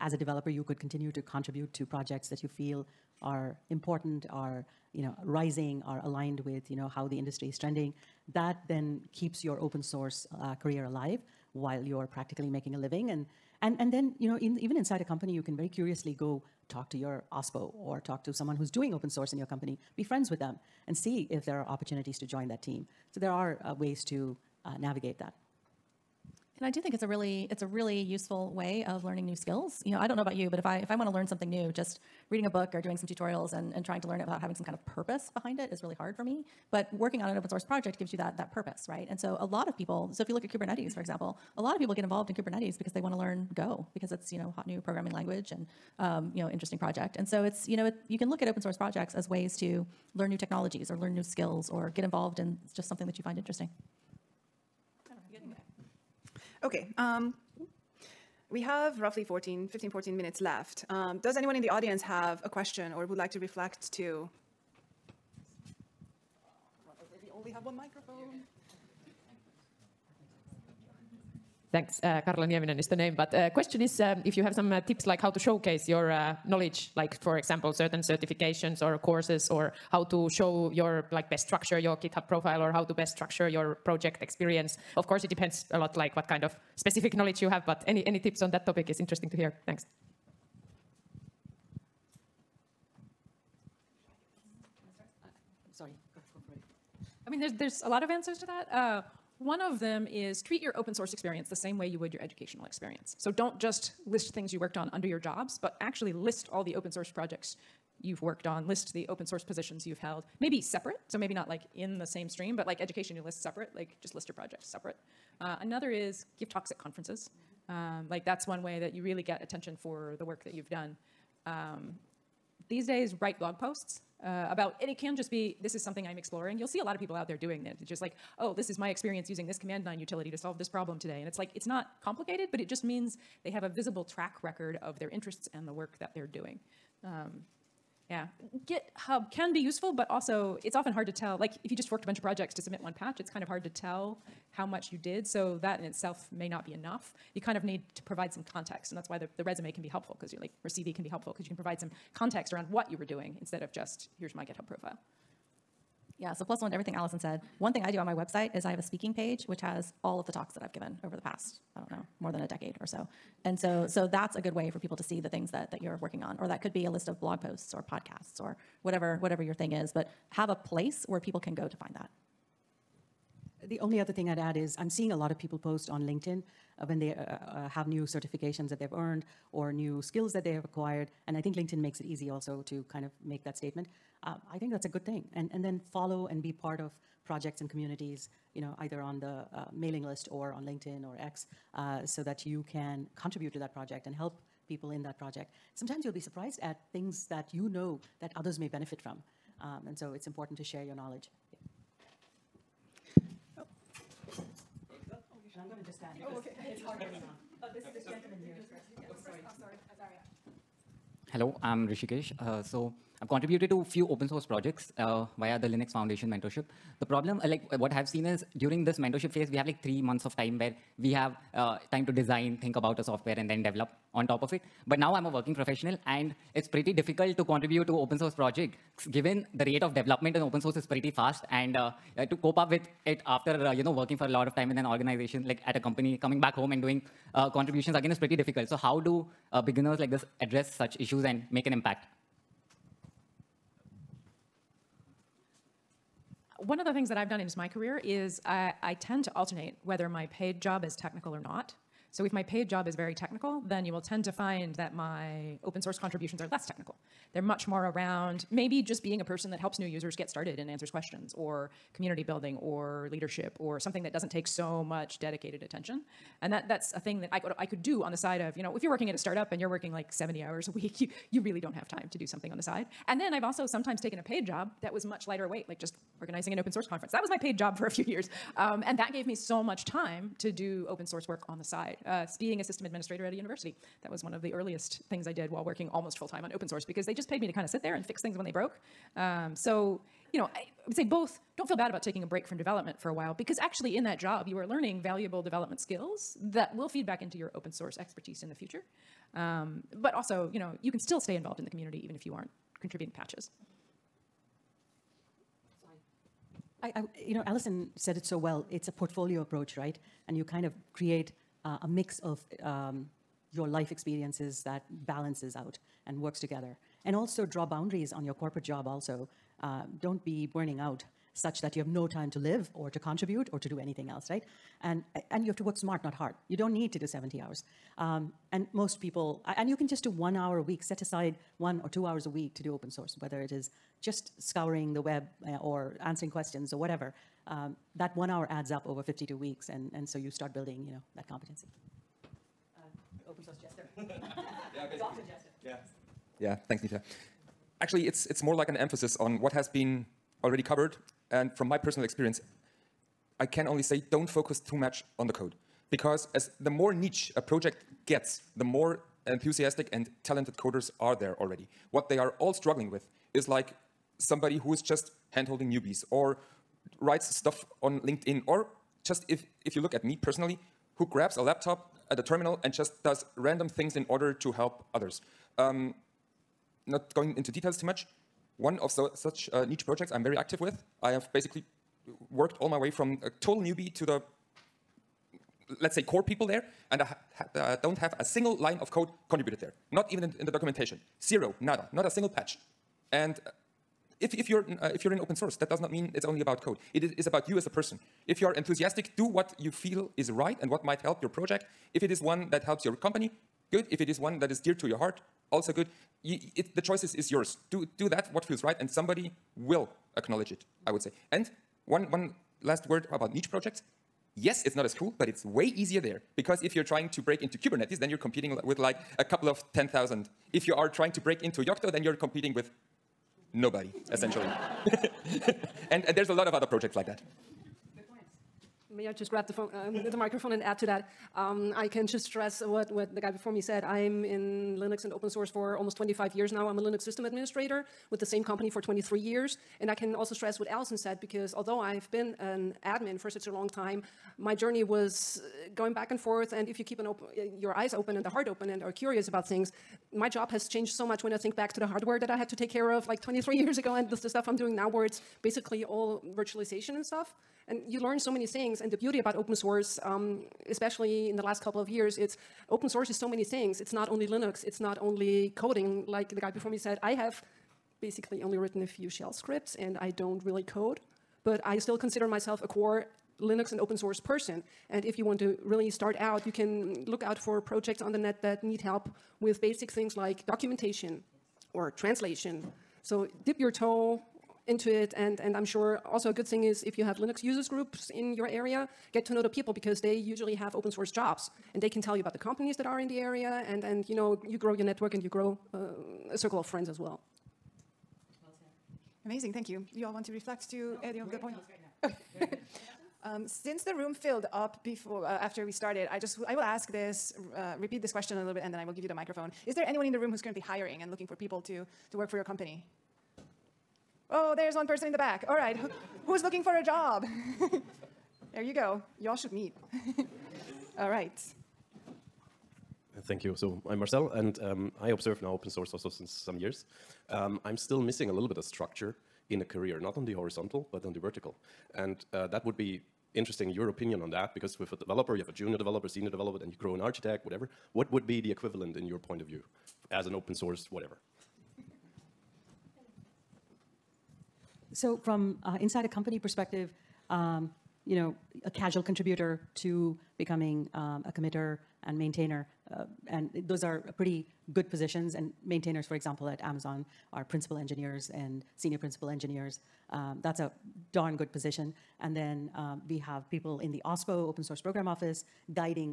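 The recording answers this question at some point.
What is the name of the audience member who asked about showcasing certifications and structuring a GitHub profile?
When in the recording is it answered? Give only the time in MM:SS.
01:12.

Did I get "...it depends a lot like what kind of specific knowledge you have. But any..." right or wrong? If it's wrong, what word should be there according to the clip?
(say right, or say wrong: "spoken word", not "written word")
right.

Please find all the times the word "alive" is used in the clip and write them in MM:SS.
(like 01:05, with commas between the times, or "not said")
00:10.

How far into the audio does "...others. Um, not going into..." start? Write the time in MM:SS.
06:14.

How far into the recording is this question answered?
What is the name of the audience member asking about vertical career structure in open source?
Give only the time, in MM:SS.
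08:43.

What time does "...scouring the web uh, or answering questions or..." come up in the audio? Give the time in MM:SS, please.
05:34.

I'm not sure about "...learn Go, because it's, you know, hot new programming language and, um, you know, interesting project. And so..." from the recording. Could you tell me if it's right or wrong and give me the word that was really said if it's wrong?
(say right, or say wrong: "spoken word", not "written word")
right.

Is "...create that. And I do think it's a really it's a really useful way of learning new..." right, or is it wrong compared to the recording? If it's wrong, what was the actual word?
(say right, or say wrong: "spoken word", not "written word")
wrong: "navigate", not "create".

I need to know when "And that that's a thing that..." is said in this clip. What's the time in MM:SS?
04:26.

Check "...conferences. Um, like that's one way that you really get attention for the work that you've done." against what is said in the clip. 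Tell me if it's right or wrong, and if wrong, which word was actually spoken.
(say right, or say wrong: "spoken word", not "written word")
right.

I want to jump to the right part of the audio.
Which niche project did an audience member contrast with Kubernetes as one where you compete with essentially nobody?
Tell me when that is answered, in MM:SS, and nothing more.
07:01.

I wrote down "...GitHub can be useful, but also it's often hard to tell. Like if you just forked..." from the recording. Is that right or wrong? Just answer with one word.
right.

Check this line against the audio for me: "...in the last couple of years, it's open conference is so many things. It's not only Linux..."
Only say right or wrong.
wrong.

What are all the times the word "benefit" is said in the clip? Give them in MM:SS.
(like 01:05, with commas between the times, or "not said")
03:18.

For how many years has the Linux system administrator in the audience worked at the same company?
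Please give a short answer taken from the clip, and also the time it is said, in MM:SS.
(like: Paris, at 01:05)
23, at 07:18.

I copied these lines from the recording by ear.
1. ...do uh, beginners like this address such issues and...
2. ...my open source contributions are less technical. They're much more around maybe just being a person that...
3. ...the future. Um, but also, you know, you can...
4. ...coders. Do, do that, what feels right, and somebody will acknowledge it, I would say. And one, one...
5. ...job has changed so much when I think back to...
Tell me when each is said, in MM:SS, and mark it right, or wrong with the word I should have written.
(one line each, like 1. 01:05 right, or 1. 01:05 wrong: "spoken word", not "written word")
1. 03:58 right
2. 04:14 right
3. 04:58 right
4. 06:47 wrong: "yours", not "coders"
5. 07:30 right.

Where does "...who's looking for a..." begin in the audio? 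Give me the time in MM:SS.
08:36.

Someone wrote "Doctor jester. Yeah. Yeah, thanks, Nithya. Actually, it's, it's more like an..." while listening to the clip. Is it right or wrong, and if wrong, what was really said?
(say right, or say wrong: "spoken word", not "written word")
right.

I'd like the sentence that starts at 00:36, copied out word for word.
But working on an open source project gives you that, that purpose, right?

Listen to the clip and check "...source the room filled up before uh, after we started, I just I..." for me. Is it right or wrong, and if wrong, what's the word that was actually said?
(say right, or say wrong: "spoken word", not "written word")
wrong: "since", not "source".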